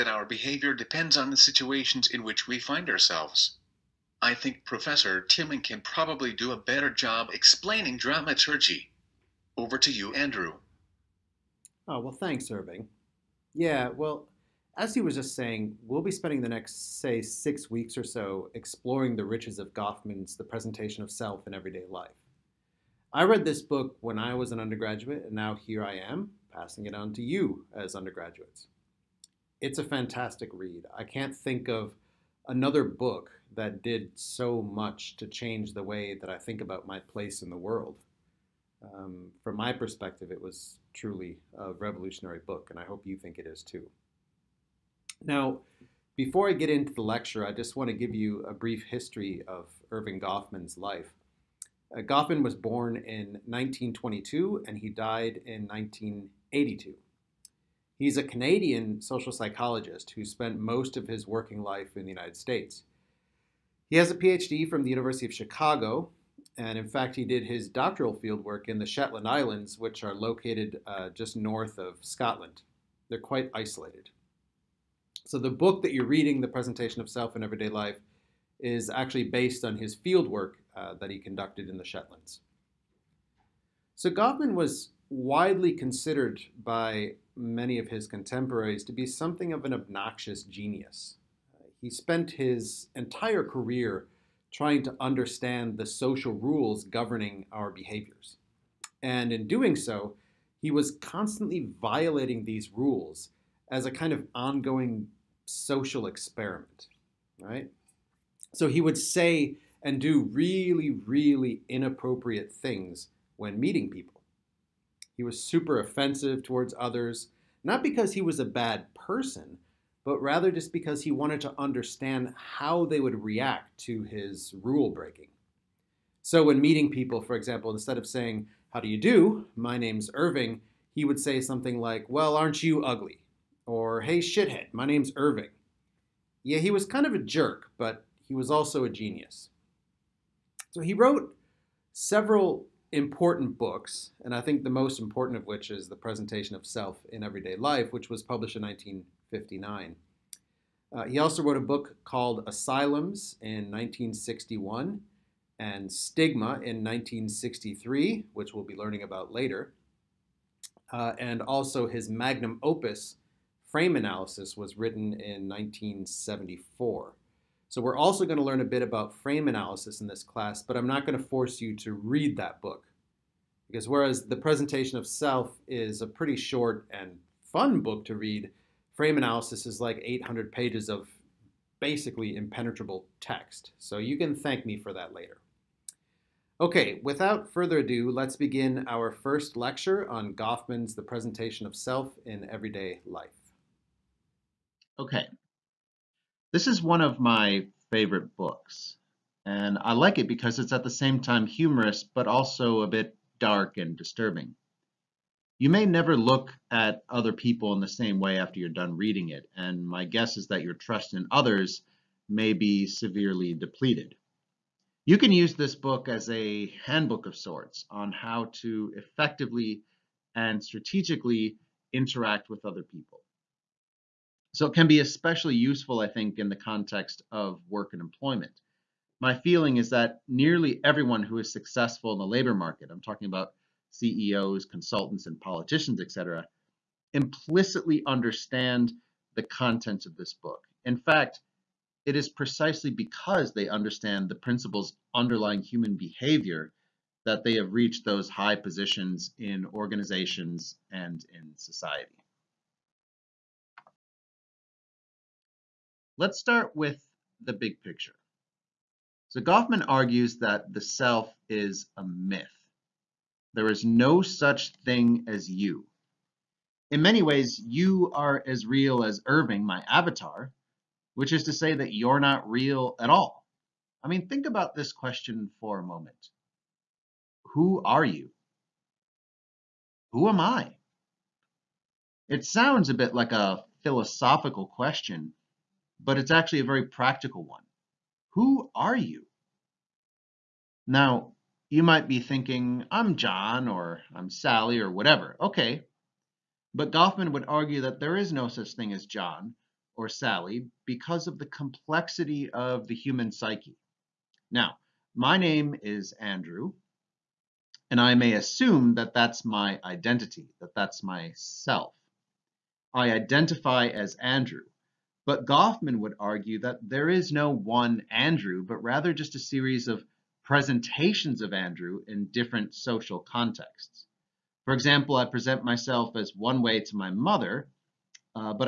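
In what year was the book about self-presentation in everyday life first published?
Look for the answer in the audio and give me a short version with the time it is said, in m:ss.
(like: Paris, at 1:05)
1959, at 2:28.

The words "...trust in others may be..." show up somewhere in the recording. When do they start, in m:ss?
3:30.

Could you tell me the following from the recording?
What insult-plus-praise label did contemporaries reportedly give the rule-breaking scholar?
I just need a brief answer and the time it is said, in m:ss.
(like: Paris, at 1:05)
obnoxious genius, at 1:29.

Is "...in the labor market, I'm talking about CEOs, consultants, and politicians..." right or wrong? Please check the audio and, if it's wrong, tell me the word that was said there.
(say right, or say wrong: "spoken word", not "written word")
right.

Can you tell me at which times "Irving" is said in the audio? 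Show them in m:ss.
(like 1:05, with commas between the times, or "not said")
0:12, 2:10, 2:15, 4:29.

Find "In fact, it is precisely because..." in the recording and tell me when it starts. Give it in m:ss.
4:00.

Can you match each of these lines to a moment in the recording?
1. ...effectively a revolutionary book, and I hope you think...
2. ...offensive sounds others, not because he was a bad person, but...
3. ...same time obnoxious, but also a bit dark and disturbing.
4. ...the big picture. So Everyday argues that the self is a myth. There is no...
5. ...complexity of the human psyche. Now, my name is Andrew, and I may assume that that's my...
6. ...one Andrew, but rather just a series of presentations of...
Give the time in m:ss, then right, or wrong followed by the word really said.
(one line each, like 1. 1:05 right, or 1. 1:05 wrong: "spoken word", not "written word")
1. 0:40 wrong: "truly", not "effectively"
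2. 1:55 wrong: "towards", not "sounds"
3. 3:20 wrong: "humorous", not "obnoxious"
4. 4:17 wrong: "Goffman", not "Everyday"
5. 5:01 right
6. 5:17 right.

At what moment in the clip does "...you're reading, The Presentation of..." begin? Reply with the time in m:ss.
1:15.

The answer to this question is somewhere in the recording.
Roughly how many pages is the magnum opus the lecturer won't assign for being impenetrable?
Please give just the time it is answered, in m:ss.
3:00.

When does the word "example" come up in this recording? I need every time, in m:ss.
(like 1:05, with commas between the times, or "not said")
2:07, 5:24.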